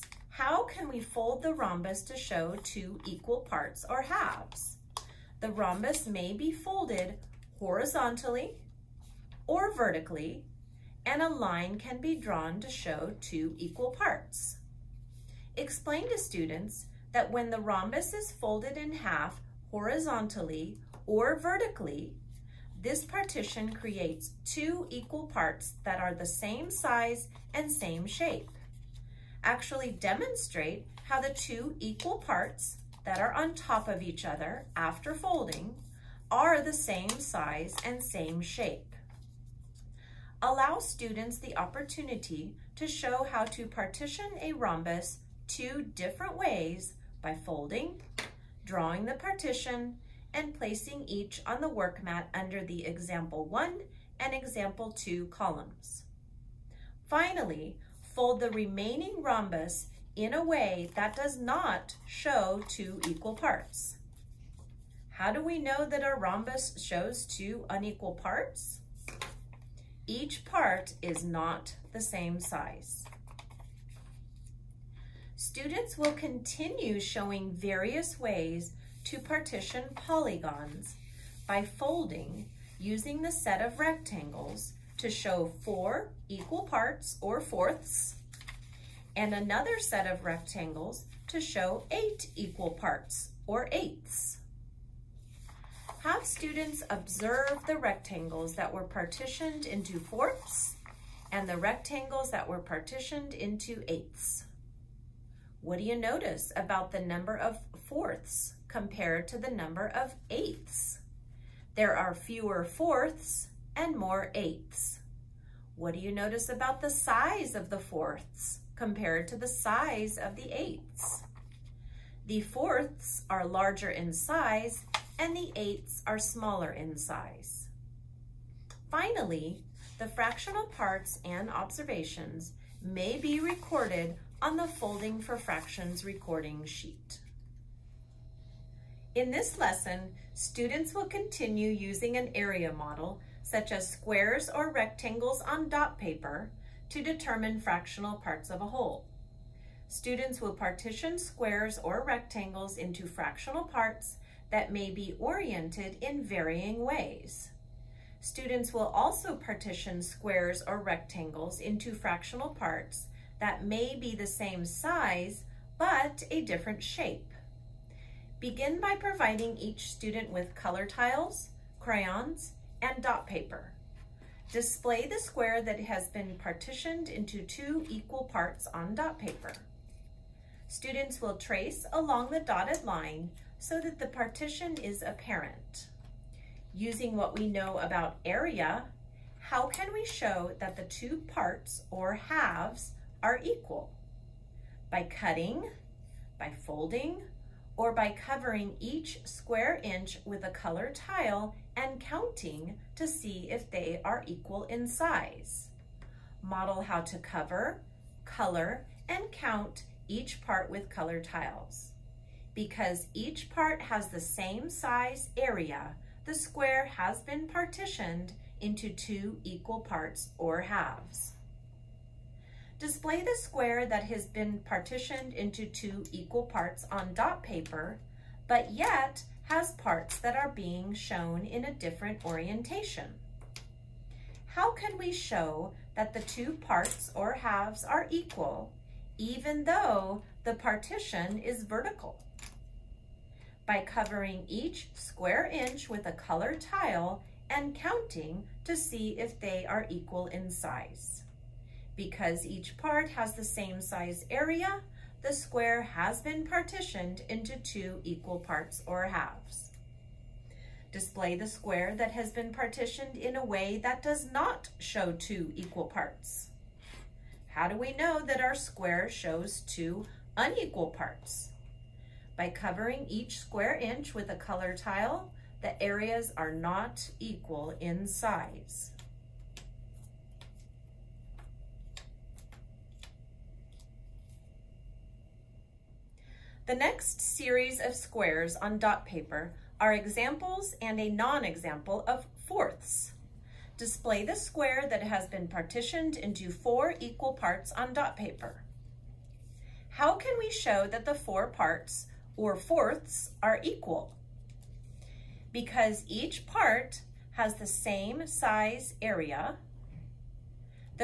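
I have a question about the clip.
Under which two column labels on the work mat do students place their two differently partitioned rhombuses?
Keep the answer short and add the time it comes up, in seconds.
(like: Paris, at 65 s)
example 1 and example 2, at 52 s.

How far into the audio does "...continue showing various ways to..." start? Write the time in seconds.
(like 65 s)
76 s.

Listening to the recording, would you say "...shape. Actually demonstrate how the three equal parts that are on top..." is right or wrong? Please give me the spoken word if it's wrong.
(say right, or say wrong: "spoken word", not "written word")
wrong: "two", not "three".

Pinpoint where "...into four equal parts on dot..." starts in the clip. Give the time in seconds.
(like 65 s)
296 s.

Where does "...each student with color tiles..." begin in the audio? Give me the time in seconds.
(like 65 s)
169 s.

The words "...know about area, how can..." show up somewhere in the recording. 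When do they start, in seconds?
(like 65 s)
187 s.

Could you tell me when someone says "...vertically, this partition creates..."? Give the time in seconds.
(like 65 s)
21 s.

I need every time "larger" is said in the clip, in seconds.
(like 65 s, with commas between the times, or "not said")
123 s.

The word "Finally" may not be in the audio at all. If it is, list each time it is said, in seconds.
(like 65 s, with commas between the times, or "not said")
57 s, 128 s.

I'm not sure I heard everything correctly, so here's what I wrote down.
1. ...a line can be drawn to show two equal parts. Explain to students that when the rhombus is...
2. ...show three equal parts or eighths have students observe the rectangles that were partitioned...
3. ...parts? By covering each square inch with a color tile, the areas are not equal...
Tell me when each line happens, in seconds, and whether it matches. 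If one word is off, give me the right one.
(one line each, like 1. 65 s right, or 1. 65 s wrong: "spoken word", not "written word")
1. 11 s right
2. 91 s wrong: "eight", not "three"
3. 270 s right.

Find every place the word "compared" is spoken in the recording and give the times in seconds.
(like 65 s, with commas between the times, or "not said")
108 s, 118 s.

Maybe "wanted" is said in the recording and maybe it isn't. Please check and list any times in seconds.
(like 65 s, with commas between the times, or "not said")
not said.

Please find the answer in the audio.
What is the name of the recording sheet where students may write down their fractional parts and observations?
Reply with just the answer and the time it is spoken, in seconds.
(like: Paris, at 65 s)
Folding for Fractions, at 134 s.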